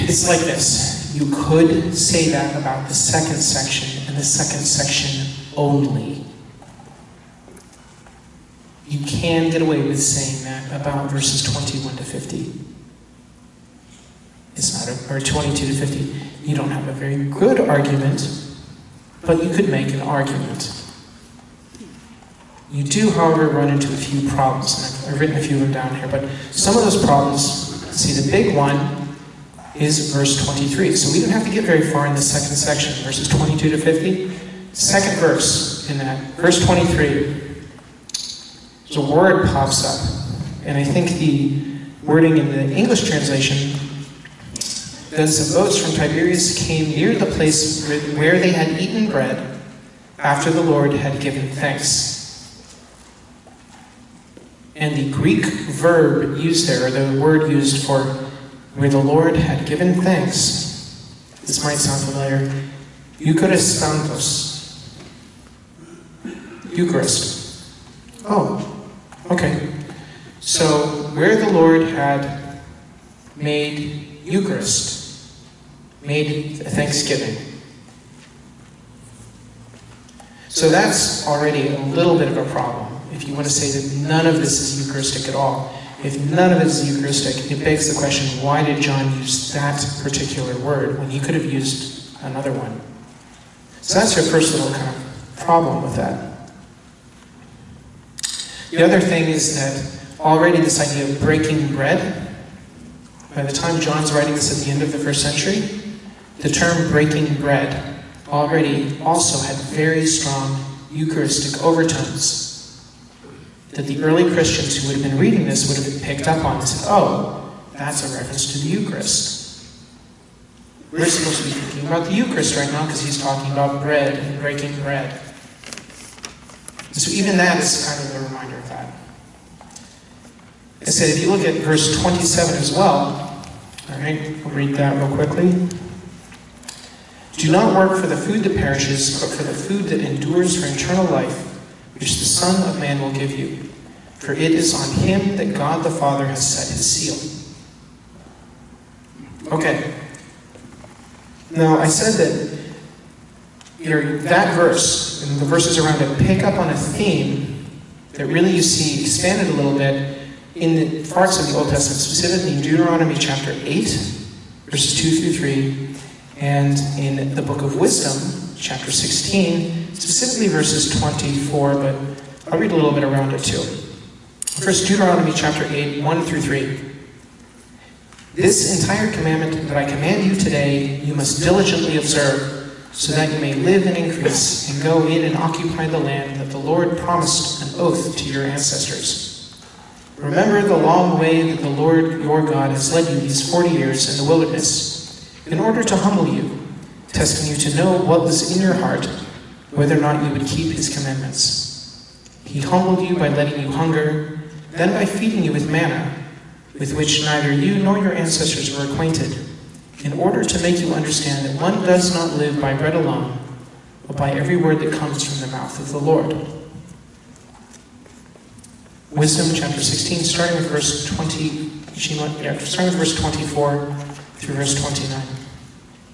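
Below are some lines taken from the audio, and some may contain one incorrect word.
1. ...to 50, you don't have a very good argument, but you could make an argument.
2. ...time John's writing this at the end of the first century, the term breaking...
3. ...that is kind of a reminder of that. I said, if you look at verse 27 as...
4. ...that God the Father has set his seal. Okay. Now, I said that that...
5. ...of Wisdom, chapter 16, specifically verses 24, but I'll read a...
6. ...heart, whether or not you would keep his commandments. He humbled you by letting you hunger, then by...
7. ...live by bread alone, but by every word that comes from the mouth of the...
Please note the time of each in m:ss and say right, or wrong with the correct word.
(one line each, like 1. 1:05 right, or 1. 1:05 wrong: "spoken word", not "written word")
1. 0:15 right
2. 1:43 right
3. 2:07 right
4. 2:25 right
5. 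2:47 right
6. 3:18 right
7. 3:32 right.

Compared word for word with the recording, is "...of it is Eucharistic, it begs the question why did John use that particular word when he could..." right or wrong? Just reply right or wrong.
right.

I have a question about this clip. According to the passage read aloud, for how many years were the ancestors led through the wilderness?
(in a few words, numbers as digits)
40.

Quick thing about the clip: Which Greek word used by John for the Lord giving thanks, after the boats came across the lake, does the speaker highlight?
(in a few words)
Eucharistantos.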